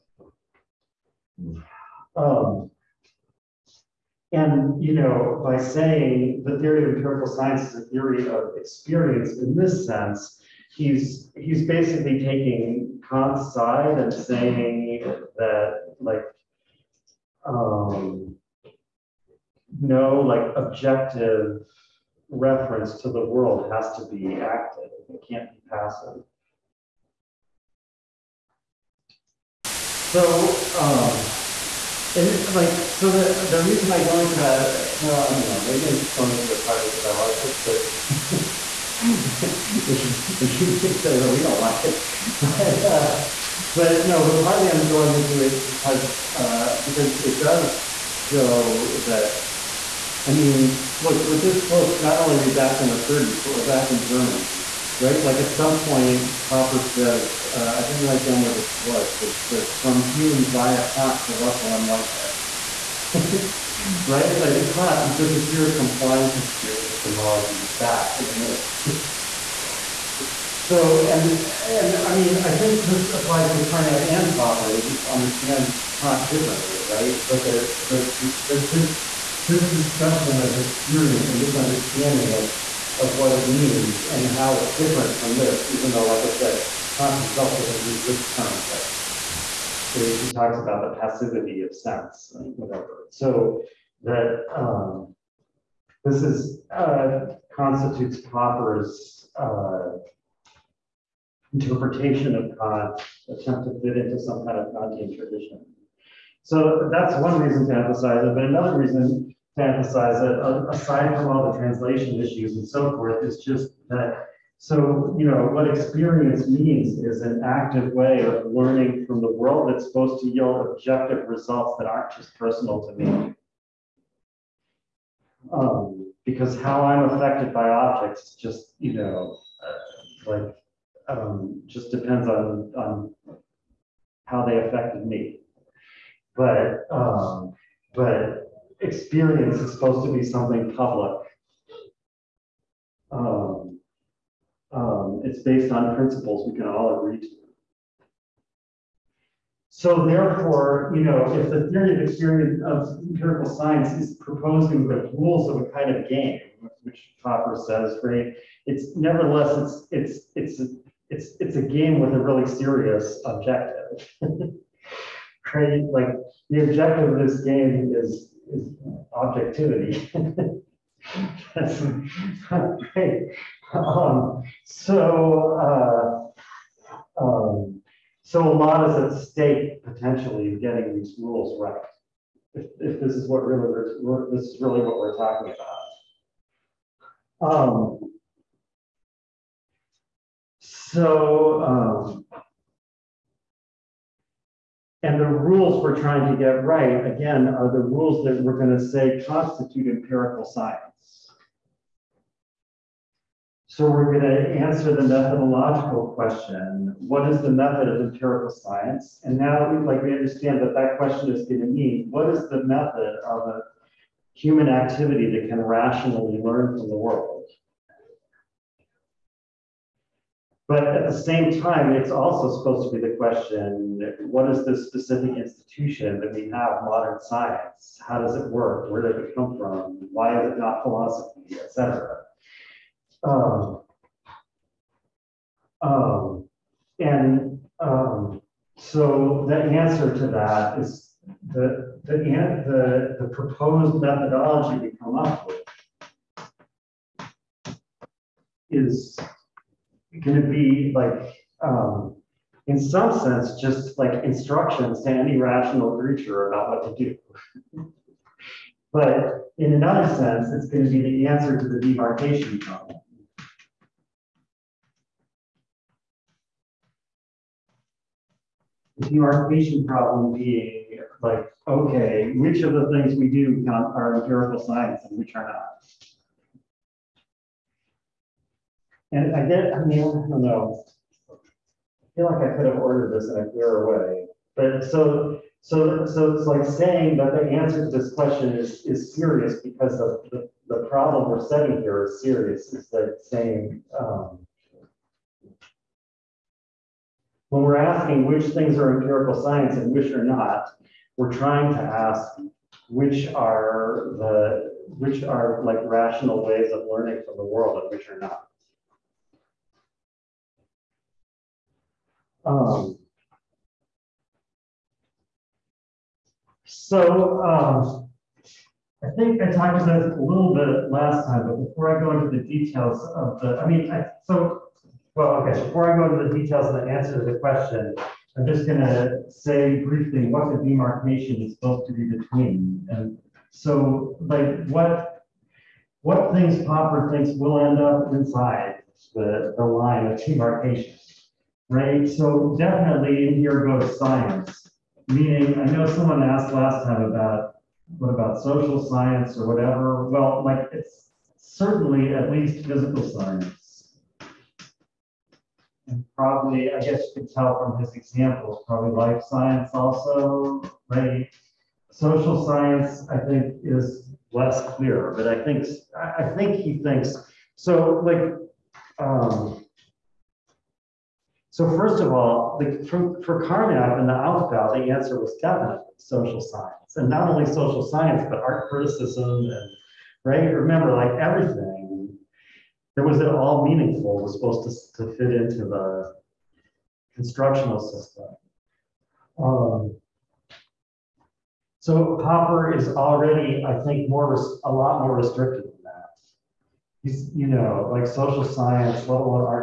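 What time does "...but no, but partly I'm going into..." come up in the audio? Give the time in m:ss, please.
0:43.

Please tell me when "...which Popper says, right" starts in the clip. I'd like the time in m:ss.
2:36.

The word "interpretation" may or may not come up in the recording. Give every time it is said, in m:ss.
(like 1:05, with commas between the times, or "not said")
1:41.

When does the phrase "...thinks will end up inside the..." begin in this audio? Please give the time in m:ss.
5:37.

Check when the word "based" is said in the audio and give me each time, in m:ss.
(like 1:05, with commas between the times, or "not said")
2:25.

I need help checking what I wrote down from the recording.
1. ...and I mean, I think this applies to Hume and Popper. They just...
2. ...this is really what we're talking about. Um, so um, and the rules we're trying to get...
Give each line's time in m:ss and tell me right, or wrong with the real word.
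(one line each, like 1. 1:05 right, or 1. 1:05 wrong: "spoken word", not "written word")
1. 1:11 wrong: "Carnap", not "Hume"
2. 3:04 right.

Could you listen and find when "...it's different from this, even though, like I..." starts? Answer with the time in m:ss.
1:24.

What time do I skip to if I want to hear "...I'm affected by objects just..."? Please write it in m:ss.
2:06.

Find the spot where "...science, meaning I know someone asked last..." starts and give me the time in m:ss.
5:43.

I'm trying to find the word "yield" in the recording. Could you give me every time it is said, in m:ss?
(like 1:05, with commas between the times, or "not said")
2:00.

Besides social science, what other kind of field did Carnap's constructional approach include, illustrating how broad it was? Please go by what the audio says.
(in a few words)
Art criticism.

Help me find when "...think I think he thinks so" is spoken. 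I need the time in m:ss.
6:05.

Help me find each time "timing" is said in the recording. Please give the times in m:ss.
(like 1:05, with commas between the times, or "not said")
not said.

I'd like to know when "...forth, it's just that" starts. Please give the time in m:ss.
1:52.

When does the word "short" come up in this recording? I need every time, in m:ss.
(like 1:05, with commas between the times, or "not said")
not said.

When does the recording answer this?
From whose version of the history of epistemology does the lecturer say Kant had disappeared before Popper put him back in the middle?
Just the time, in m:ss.
1:05.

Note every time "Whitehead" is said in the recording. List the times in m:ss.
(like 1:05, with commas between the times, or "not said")
1:01.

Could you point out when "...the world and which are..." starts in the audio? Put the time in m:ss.
5:07.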